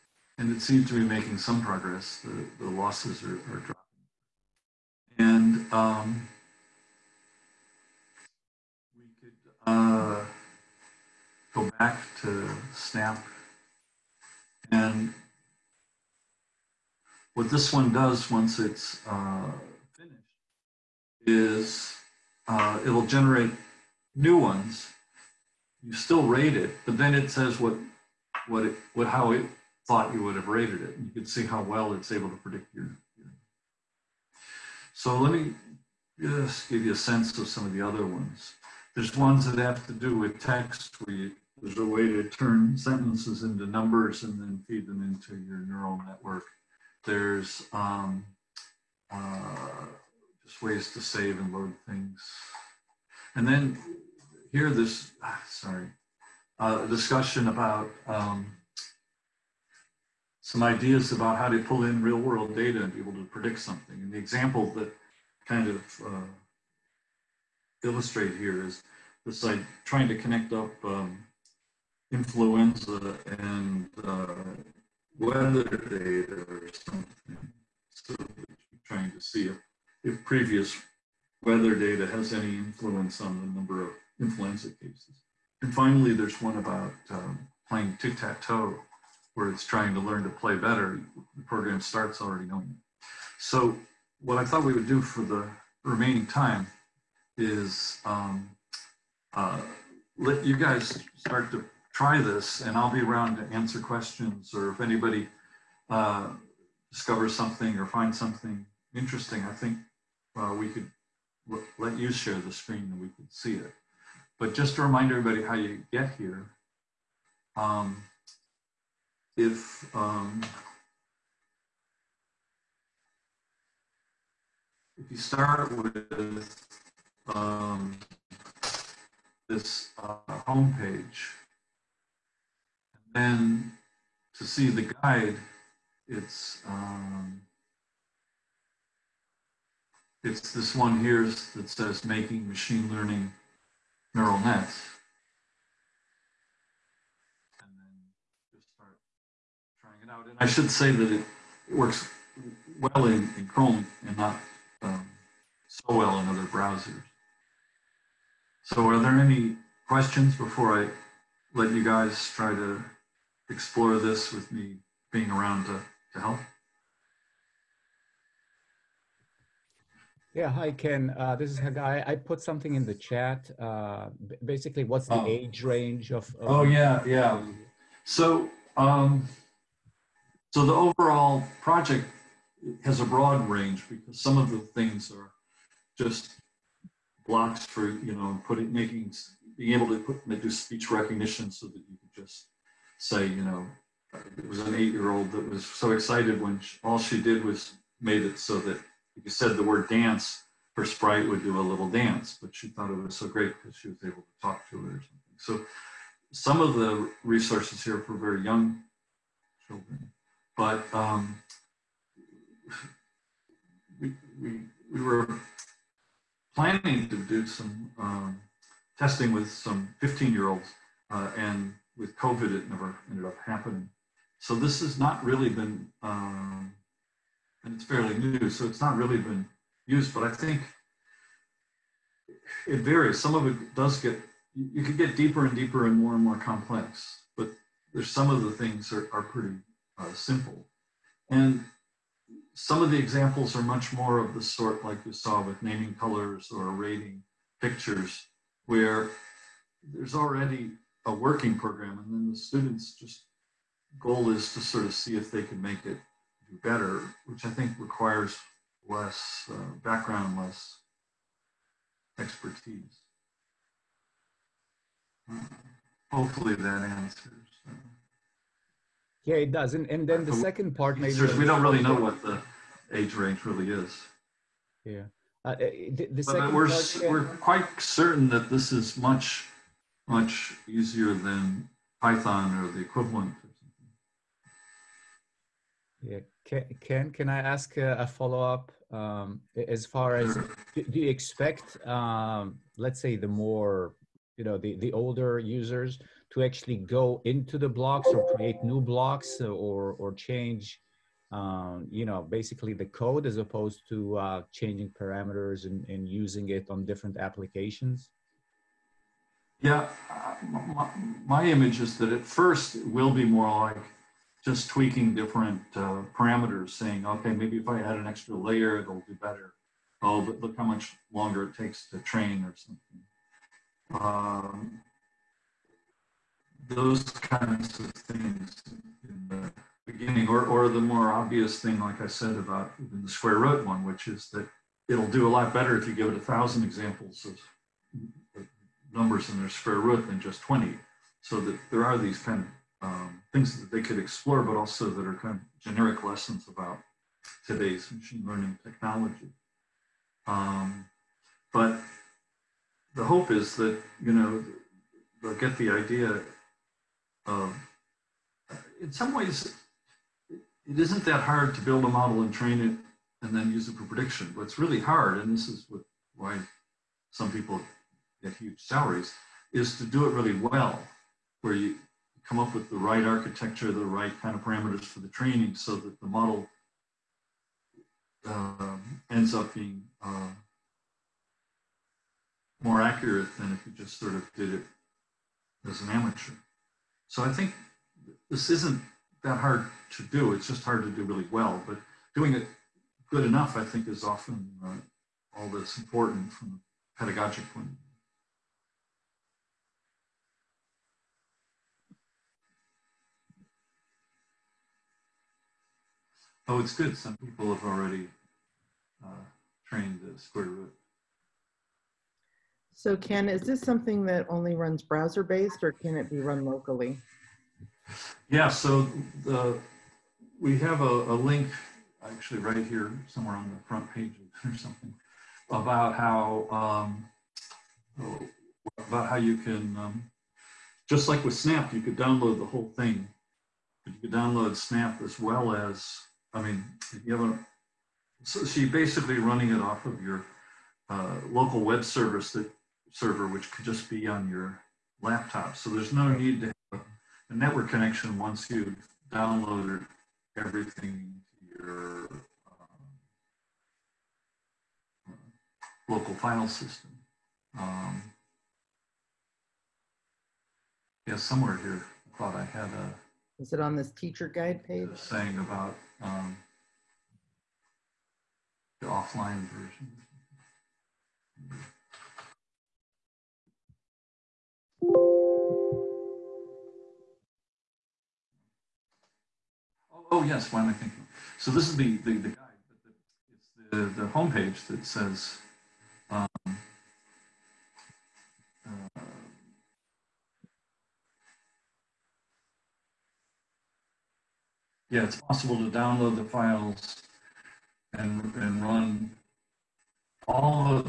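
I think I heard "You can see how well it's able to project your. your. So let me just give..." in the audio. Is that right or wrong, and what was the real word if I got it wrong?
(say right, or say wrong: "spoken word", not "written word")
wrong: "predict", not "project".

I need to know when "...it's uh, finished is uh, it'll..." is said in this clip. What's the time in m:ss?
0:18.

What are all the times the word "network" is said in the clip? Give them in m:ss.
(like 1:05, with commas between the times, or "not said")
0:46, 7:27.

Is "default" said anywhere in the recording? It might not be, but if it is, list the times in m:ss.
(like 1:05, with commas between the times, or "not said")
not said.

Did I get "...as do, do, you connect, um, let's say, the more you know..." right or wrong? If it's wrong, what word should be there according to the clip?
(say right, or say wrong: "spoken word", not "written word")
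wrong: "expect", not "connect".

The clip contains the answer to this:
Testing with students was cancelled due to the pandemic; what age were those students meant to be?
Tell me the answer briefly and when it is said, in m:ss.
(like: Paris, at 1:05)
15, at 3:40.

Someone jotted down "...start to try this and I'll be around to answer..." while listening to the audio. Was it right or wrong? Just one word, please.
right.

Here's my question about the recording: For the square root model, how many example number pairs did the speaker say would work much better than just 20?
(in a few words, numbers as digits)
1000.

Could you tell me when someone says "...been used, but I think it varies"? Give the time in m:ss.
3:49.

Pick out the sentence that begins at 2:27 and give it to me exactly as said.
And then just start trying it out.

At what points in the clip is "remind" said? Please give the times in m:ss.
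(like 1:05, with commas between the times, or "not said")
1:54.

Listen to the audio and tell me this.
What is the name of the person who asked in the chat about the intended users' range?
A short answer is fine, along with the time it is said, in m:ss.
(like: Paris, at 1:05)
Hagai, at 2:51.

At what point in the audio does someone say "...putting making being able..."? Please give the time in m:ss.
3:08.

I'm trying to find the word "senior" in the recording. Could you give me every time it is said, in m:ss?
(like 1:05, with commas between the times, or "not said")
not said.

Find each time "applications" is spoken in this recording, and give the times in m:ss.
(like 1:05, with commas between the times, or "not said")
5:07.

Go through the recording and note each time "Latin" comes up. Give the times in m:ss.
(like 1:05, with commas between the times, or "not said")
not said.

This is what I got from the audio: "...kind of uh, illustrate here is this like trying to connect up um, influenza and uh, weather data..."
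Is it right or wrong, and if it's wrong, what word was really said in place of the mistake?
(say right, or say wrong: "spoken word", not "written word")
right.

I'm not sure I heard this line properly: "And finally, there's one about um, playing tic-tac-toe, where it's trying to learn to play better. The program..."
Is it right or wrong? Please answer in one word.
right.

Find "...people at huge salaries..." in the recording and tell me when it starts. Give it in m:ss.
6:07.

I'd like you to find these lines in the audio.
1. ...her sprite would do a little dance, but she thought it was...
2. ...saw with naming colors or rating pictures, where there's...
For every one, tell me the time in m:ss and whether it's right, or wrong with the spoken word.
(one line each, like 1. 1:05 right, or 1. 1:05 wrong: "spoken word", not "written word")
1. 3:20 right
2. 4:05 right.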